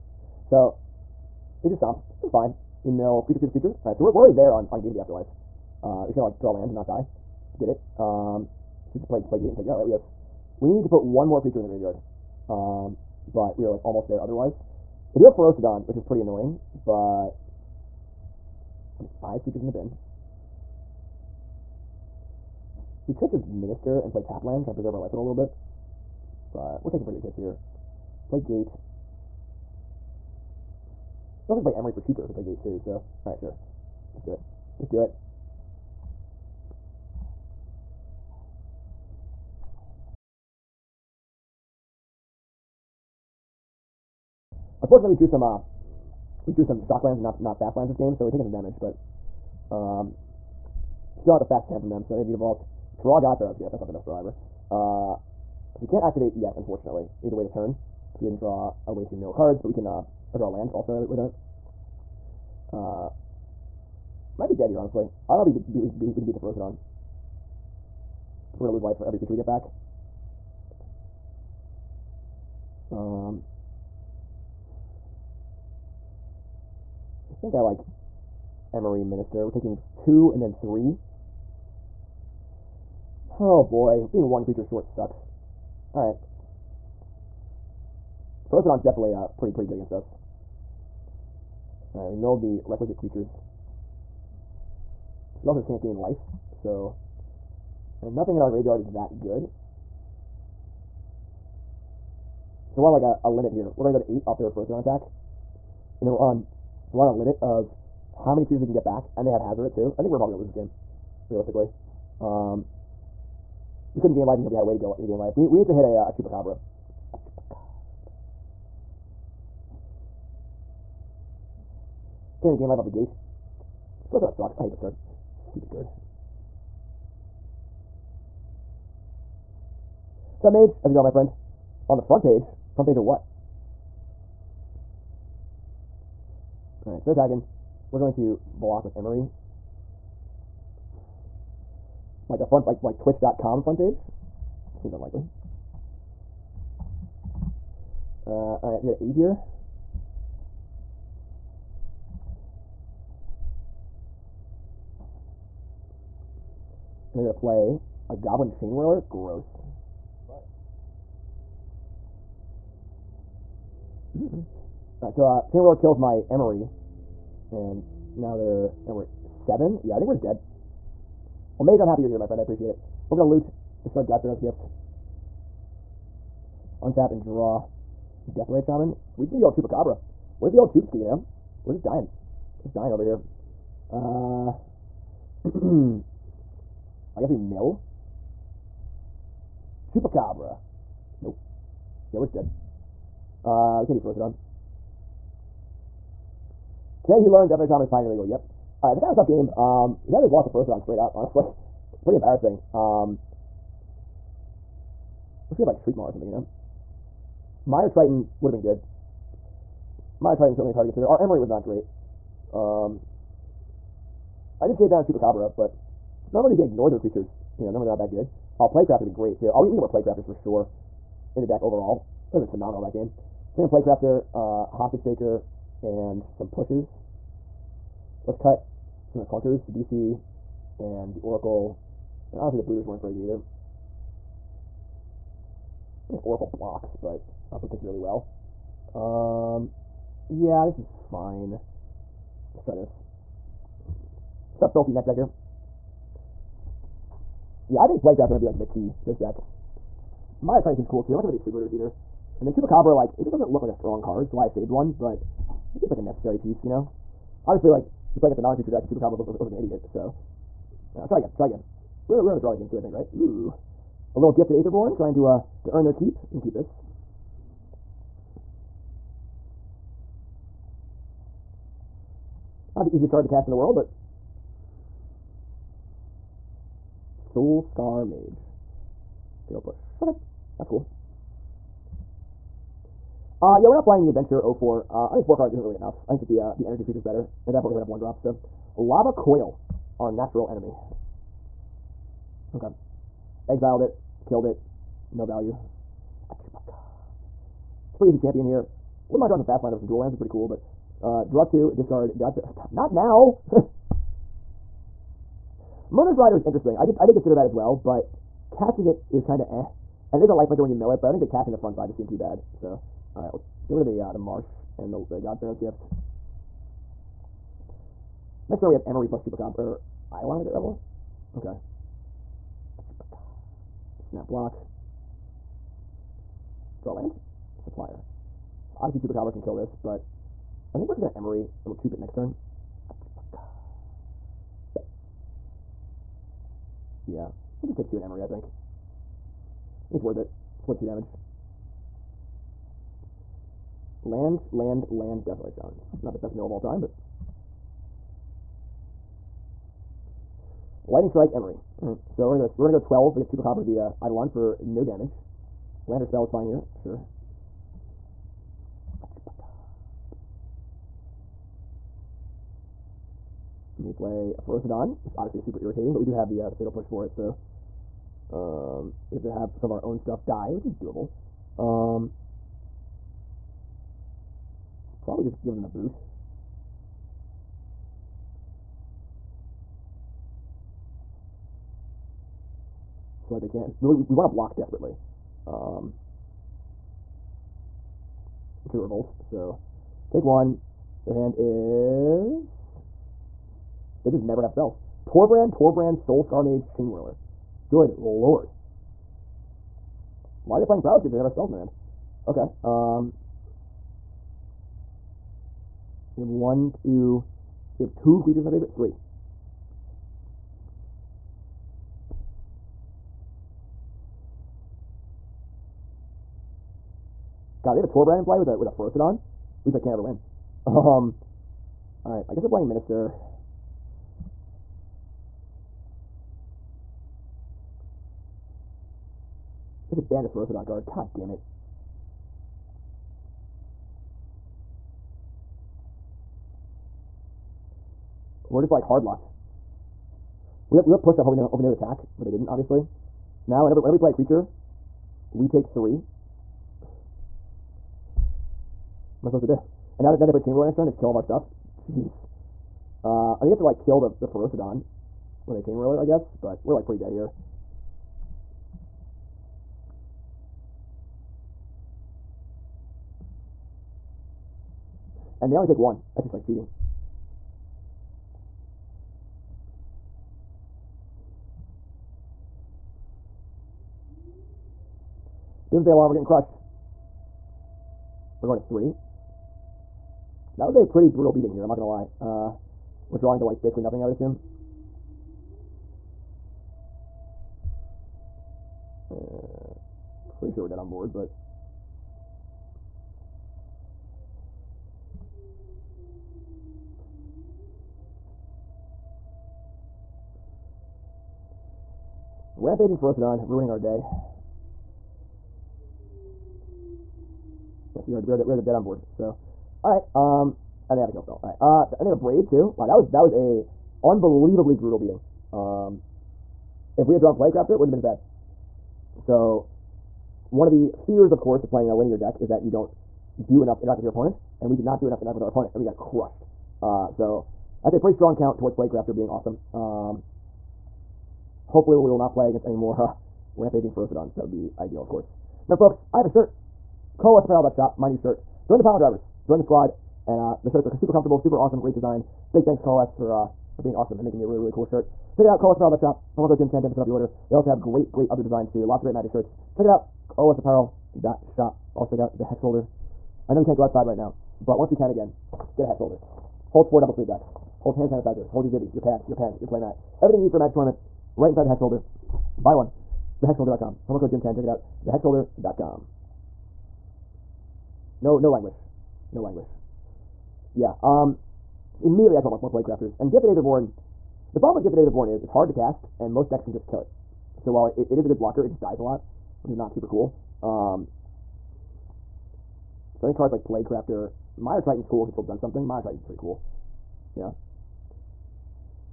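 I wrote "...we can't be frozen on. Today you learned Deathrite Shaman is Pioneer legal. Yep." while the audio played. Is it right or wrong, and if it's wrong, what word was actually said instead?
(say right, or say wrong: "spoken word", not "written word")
right.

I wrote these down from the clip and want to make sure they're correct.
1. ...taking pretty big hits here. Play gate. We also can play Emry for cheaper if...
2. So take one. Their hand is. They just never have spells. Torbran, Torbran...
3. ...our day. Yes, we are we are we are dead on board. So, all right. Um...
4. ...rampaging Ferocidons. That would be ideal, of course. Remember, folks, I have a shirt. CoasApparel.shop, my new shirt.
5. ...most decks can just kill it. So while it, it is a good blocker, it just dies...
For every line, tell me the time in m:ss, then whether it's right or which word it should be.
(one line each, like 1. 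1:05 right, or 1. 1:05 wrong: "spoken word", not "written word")
1. 0:26 right
2. 6:29 right
3. 8:23 right
4. 8:53 right
5. 9:36 right.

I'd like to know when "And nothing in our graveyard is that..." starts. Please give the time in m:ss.
1:38.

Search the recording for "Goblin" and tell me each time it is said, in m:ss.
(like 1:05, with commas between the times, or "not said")
2:38.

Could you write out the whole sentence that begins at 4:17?
Obviously, like, we play against a non-creature deck, and Chupacabra looks, looks, looks like an idiot, so...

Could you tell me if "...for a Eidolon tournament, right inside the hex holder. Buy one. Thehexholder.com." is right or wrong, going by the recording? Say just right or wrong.
wrong.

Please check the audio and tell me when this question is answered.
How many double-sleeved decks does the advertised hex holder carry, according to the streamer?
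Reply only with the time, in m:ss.
9:16.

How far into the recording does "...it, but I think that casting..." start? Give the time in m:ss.
5:10.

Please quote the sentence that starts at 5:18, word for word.
Next draw, we have Emry plus Chupacabra, or Eidolon the Great Revel.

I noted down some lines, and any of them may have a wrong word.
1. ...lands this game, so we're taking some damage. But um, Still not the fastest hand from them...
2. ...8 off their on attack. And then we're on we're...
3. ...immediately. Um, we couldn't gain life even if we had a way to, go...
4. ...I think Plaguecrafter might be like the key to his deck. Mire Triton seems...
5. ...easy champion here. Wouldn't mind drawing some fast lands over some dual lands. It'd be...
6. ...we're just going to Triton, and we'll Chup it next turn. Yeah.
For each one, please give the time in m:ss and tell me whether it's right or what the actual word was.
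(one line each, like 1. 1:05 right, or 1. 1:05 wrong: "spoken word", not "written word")
1. 0:47 right
2. 1:44 right
3. 1:51 wrong: "realistically", not "immediately"
4. 4:07 right
5. 4:58 right
6. 5:30 wrong: "Emry", not "Triton".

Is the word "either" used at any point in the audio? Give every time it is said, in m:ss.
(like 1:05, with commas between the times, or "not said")
3:53, 4:11.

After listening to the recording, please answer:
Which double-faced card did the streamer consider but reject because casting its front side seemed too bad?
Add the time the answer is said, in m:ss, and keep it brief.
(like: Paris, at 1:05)
Murderous Rider, at 5:05.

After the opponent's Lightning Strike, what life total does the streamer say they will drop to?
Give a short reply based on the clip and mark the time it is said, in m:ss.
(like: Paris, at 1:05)
12, at 5:52.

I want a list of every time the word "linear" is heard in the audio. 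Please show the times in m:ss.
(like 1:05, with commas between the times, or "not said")
8:41.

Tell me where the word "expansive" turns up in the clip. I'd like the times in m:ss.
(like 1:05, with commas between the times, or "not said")
not said.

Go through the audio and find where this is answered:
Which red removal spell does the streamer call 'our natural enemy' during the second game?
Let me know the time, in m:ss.
4:48.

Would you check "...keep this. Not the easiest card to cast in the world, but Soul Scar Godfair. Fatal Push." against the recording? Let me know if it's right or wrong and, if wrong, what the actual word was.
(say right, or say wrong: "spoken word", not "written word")
wrong: "Mage", not "Godfair".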